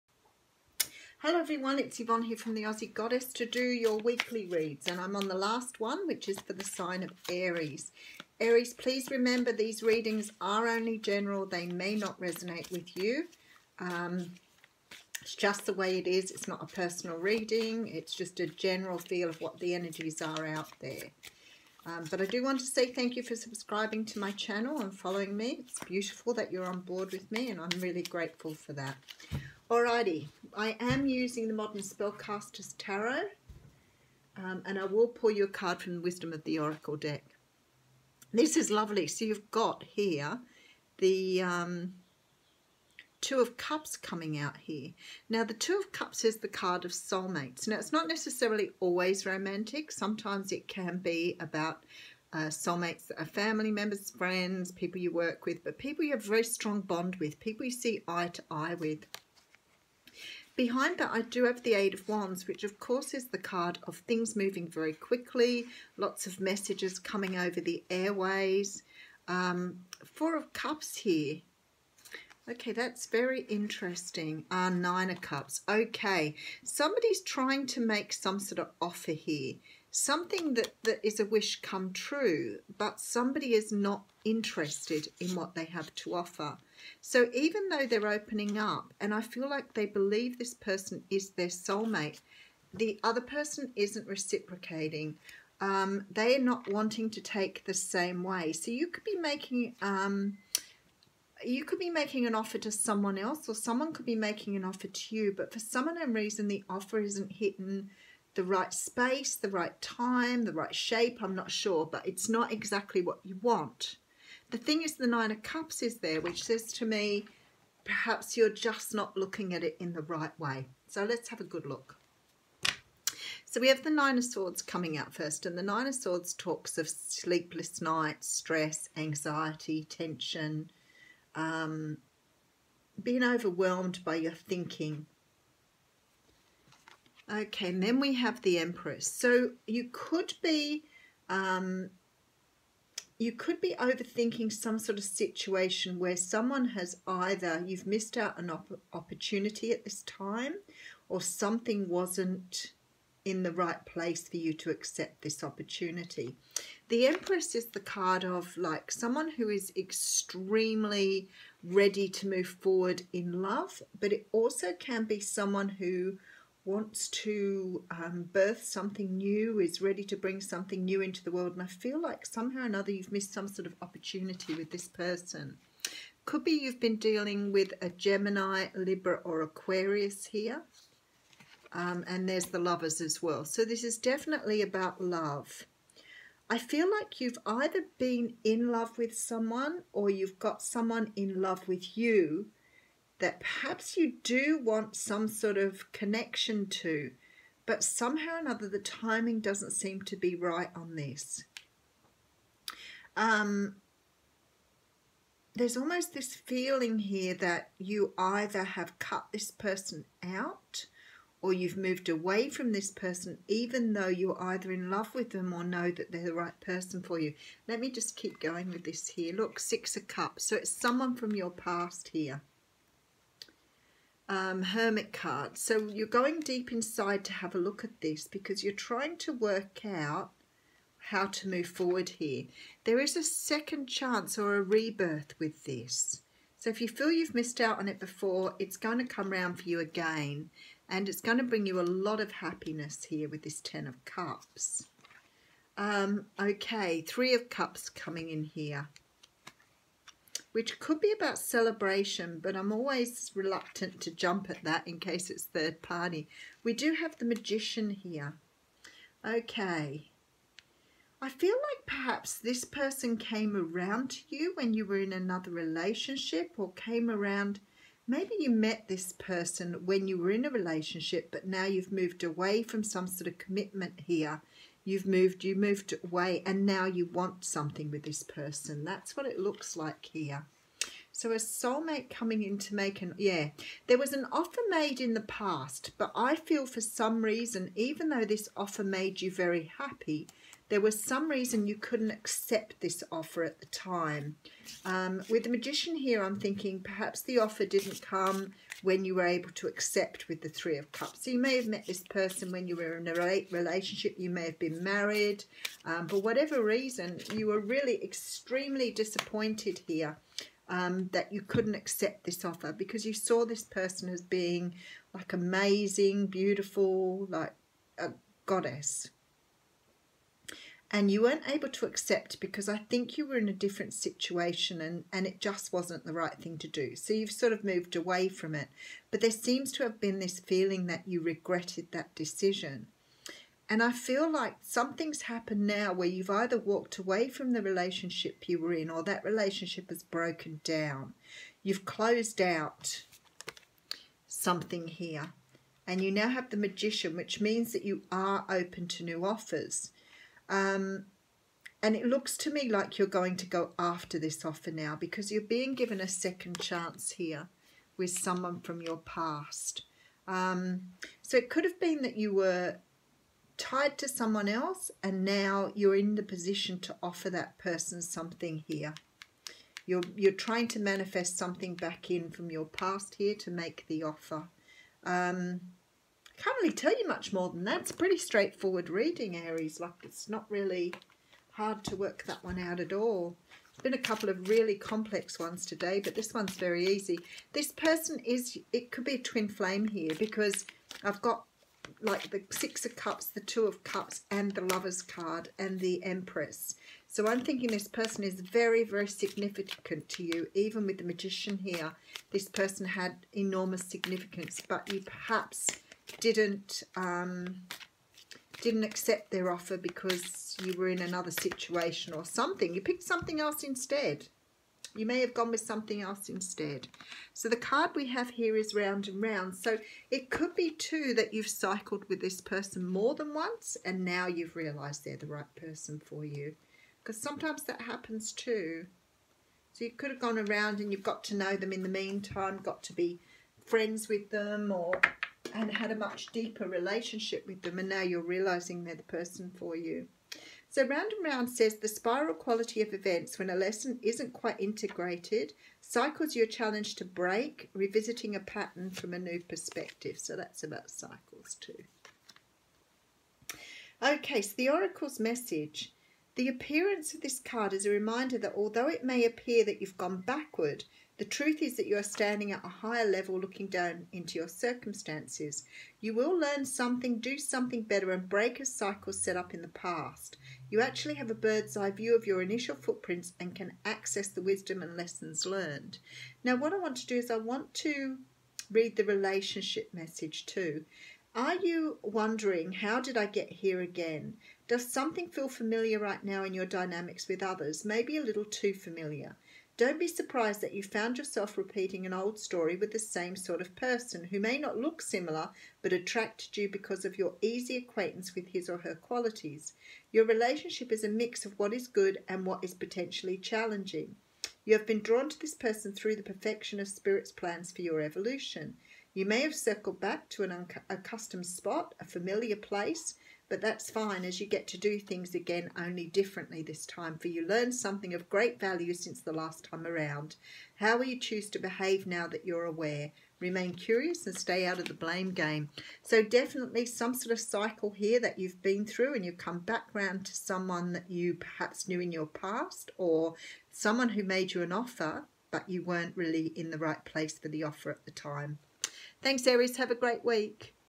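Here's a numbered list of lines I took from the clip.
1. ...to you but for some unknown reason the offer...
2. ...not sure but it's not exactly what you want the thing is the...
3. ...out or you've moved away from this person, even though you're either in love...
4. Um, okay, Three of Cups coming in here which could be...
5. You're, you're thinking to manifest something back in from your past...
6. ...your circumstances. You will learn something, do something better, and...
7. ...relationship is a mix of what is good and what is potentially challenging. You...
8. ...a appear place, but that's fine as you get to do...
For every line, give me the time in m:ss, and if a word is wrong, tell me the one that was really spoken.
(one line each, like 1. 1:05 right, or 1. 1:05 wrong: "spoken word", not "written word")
1. 1:44 right
2. 1:51 right
3. 3:30 right
4. 4:05 right
5. 6:09 wrong: "trying", not "thinking"
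6. 7:44 right
7. 8:20 right
8. 8:31 wrong: "familiar", not "appear".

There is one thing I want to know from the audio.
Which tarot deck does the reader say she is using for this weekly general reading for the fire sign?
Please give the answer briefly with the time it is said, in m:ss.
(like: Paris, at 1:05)
Modern Spellcaster's Tarot, at 0:31.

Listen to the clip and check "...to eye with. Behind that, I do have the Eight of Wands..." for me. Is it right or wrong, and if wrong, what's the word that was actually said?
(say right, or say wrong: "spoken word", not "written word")
right.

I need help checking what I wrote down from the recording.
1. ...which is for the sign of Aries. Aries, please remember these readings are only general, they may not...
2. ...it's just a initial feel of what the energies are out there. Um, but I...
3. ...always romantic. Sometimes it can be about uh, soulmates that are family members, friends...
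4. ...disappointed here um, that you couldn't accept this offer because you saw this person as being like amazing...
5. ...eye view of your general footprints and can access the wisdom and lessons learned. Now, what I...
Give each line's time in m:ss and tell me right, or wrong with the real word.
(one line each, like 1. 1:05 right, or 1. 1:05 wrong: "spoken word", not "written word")
1. 0:06 right
2. 0:17 wrong: "general", not "initial"
3. 0:48 right
4. 5:08 right
5. 7:51 wrong: "initial", not "general".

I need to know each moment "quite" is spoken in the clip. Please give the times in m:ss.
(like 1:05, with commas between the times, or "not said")
7:24.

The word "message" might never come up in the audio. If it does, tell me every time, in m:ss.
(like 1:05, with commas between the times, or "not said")
1:06, 7:35, 7:59.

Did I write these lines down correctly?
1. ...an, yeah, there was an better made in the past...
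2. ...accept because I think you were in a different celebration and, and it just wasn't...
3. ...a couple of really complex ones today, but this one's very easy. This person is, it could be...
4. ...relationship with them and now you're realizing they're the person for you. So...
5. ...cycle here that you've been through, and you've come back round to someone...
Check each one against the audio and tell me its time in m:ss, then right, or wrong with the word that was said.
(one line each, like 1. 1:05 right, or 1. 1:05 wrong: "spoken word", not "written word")
1. 4:43 wrong: "offer", not "better"
2. 5:21 wrong: "situation", not "celebration"
3. 6:23 right
4. 7:16 right
5. 8:47 right.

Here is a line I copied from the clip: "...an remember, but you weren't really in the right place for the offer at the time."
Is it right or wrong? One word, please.
wrong.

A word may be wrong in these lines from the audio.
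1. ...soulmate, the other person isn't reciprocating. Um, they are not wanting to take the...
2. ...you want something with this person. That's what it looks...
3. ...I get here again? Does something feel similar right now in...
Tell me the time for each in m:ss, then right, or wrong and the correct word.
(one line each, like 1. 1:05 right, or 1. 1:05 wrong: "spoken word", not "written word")
1. 1:31 right
2. 4:36 right
3. 8:03 wrong: "familiar", not "similar".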